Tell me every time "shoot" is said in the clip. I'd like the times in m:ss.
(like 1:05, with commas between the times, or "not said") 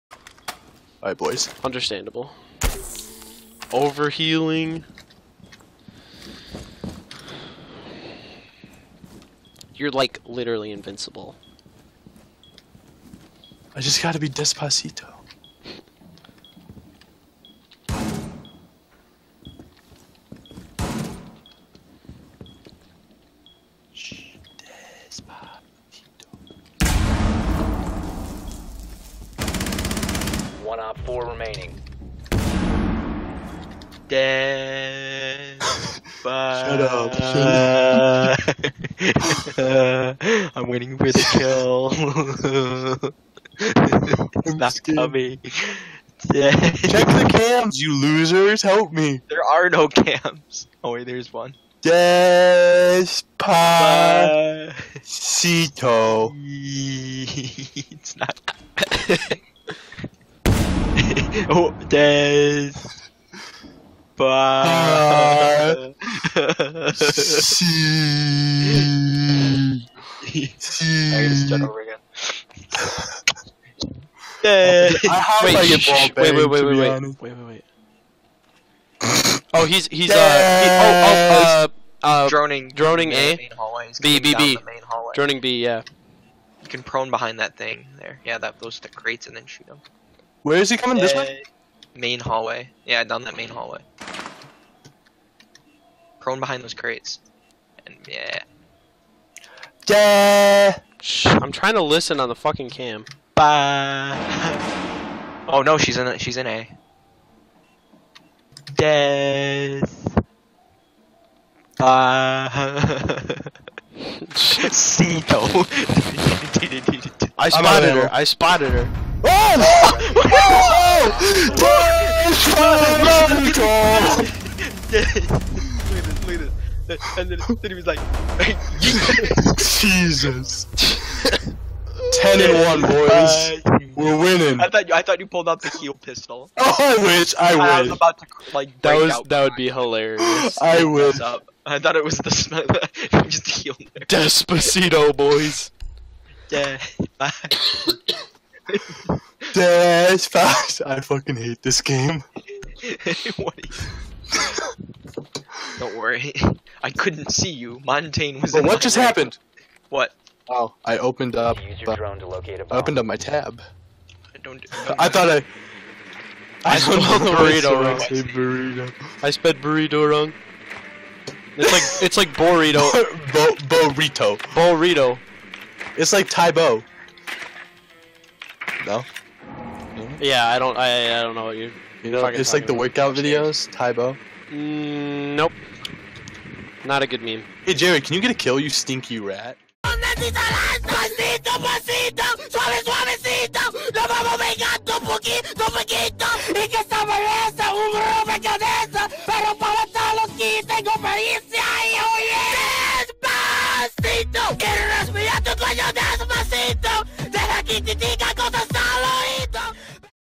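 1:29.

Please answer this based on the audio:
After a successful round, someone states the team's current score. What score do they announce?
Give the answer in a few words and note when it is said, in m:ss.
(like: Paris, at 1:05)
10 and 1, at 2:12.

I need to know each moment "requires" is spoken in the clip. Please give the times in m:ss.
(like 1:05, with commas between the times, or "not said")
not said.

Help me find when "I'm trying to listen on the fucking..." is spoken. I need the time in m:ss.
1:41.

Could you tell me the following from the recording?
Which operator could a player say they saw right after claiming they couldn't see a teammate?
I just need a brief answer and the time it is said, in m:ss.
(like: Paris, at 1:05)
Montagne, at 2:37.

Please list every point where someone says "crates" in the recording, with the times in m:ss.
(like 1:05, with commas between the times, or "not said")
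1:28, 1:36.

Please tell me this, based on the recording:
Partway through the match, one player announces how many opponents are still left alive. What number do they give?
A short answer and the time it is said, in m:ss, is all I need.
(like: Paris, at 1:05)
4, at 0:31.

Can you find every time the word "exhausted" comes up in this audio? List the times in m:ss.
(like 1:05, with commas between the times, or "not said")
not said.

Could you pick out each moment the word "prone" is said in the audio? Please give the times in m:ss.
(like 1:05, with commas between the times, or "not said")
1:26, 1:36.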